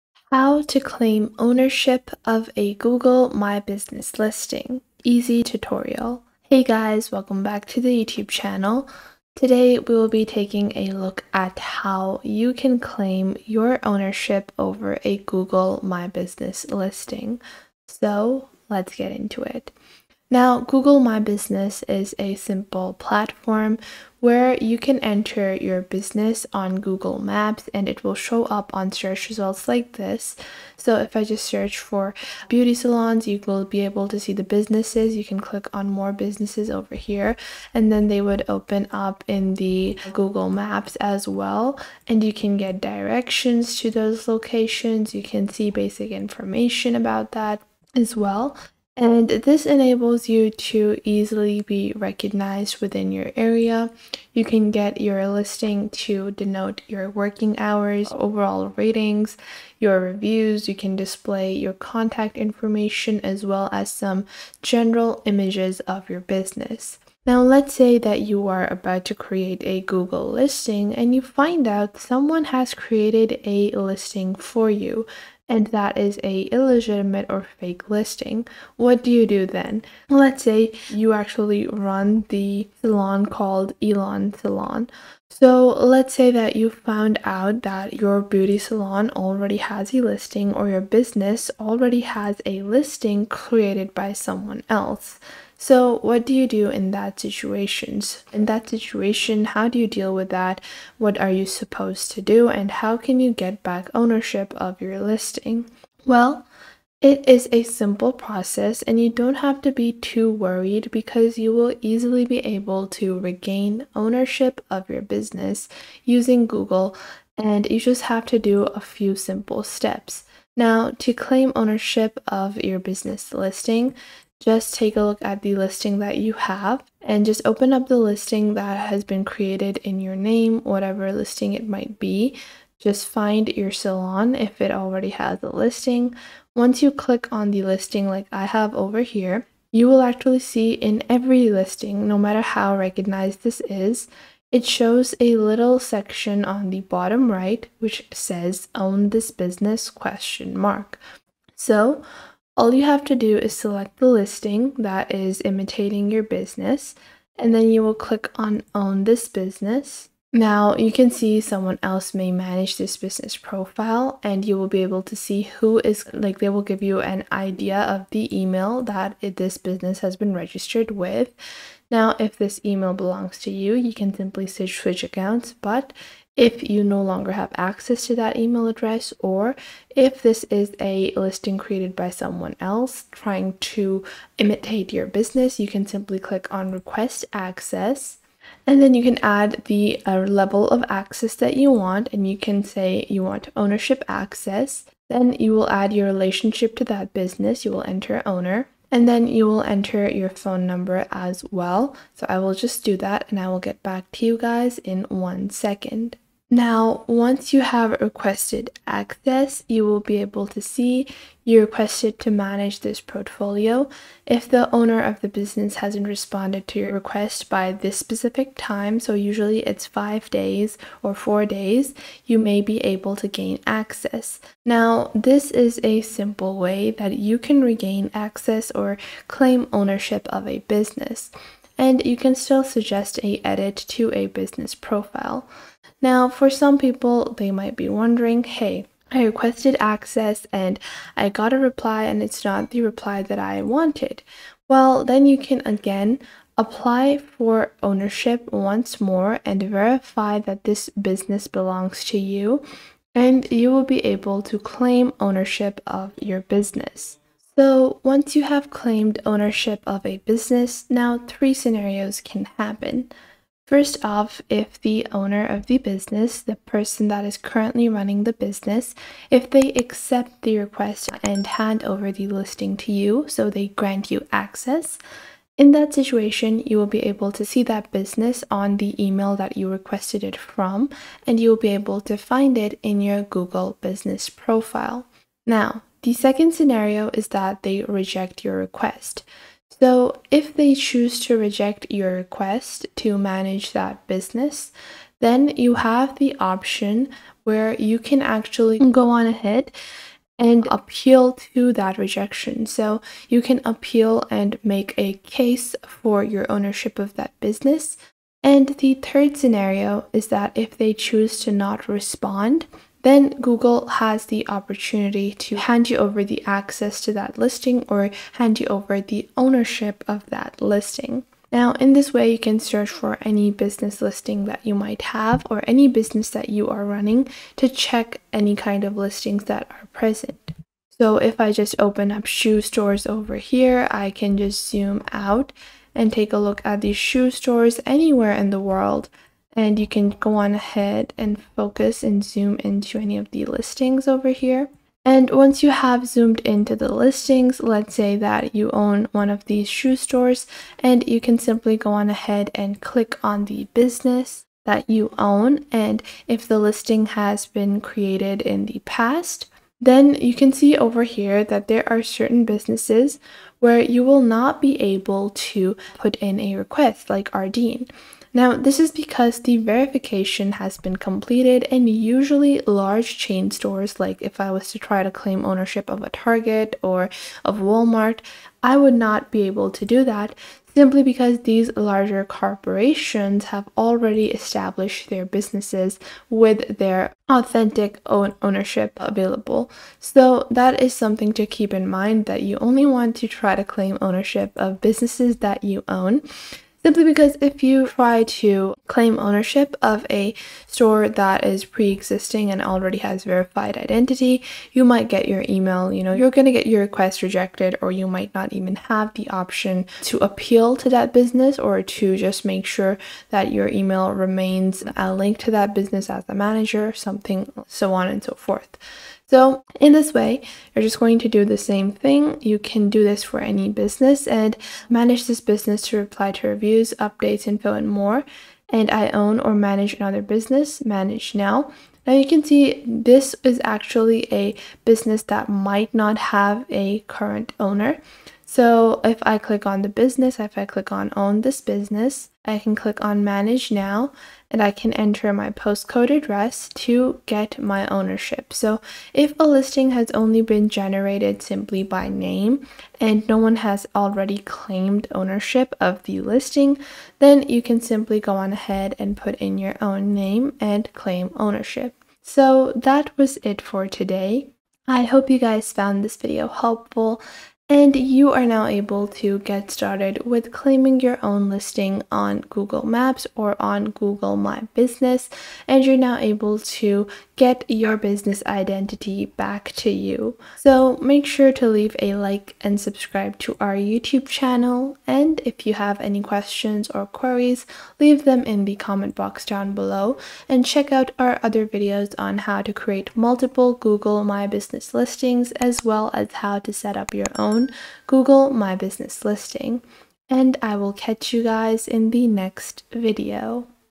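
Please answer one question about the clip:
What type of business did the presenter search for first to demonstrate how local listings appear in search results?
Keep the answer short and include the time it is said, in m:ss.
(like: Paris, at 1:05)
beauty salons, at 0:32.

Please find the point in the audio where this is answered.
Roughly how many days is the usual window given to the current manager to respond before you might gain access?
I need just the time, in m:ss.
3:39.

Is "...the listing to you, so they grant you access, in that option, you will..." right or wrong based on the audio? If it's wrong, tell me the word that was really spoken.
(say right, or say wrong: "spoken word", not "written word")
wrong: "situation", not "option".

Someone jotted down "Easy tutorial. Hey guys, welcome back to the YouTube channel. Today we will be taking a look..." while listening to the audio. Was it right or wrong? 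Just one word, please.
right.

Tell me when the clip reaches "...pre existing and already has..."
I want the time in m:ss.
6:41.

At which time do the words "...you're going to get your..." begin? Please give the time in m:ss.
6:46.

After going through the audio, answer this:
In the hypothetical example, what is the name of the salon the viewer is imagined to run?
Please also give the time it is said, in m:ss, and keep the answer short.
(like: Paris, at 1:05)
Elon Salon, at 1:23.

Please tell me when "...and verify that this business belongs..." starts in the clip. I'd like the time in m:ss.
4:09.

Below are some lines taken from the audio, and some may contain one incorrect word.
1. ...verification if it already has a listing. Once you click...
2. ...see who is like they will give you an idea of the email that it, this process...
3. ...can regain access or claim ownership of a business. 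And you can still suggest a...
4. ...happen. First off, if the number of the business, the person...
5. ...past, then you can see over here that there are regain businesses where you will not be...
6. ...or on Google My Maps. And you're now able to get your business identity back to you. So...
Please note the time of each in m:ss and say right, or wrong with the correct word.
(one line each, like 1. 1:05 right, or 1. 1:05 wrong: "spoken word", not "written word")
1. 2:13 wrong: "salon", not "verification"
2. 2:45 wrong: "business", not "process"
3. 3:47 right
4. 4:22 wrong: "owner", not "number"
5. 5:58 wrong: "certain", not "regain"
6. 7:53 wrong: "Business", not "Maps".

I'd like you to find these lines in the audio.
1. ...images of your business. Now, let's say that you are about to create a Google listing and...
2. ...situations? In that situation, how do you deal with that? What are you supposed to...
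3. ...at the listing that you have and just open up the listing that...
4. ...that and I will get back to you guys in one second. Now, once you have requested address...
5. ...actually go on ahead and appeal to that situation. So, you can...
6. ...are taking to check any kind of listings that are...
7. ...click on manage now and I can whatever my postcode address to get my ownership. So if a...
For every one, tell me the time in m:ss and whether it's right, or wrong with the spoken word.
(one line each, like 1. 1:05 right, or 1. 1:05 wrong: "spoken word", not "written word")
1. 1:05 right
2. 1:37 right
3. 2:05 right
4. 3:22 wrong: "access", not "address"
5. 4:58 wrong: "rejection", not "situation"
6. 5:26 wrong: "running", not "taking"
7. 7:22 wrong: "enter", not "whatever".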